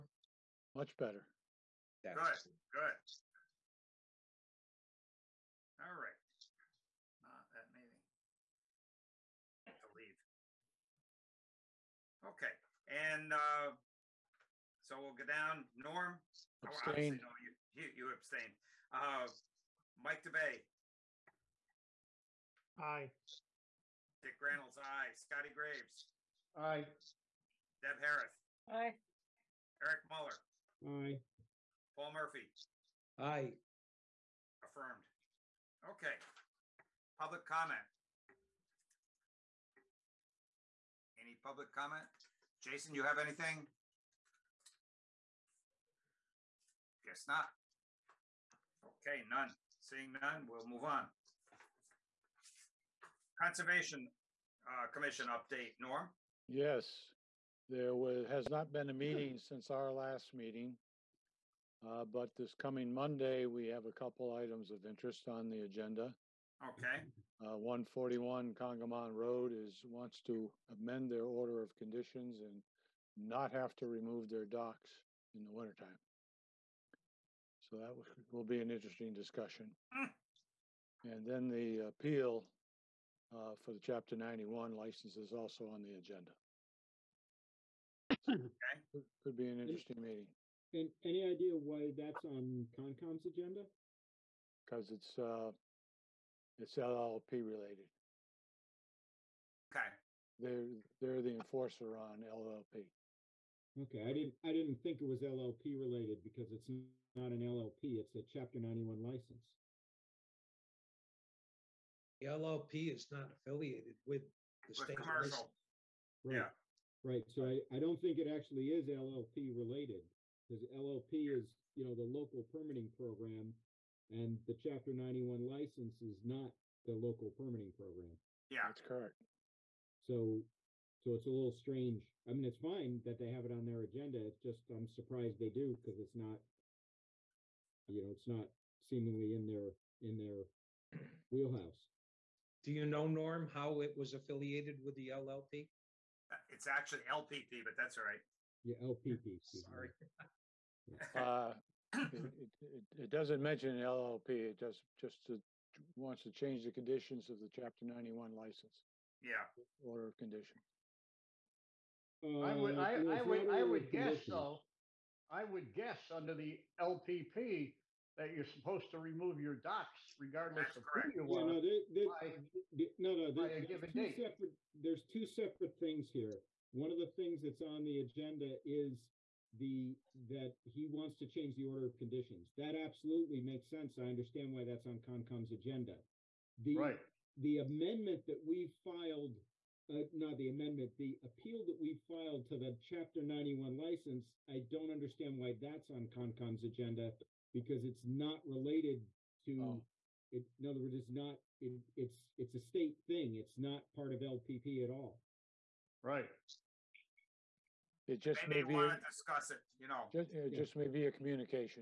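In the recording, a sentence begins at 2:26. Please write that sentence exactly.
Uh, it's actually LPP, but that's all right.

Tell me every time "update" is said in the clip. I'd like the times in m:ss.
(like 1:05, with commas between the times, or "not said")
0:55.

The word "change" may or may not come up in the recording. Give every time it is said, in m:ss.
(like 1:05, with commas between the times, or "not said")
2:36, 3:01.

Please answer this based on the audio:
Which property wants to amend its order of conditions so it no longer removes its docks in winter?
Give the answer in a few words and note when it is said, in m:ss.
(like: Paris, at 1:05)
141 Congamond Road, at 1:07.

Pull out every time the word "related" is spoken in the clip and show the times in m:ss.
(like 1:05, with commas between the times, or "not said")
1:37, 1:45, 1:59, 3:18.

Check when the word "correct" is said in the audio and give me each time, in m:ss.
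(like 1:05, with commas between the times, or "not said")
2:08, 2:50.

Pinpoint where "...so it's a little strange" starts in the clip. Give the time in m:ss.
2:11.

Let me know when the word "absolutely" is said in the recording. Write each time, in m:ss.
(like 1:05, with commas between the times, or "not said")
3:02.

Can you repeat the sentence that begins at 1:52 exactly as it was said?
The LLP is not affiliated with the state.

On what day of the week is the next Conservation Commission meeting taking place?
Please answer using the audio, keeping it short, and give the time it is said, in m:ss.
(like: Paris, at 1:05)
Monday, at 1:02.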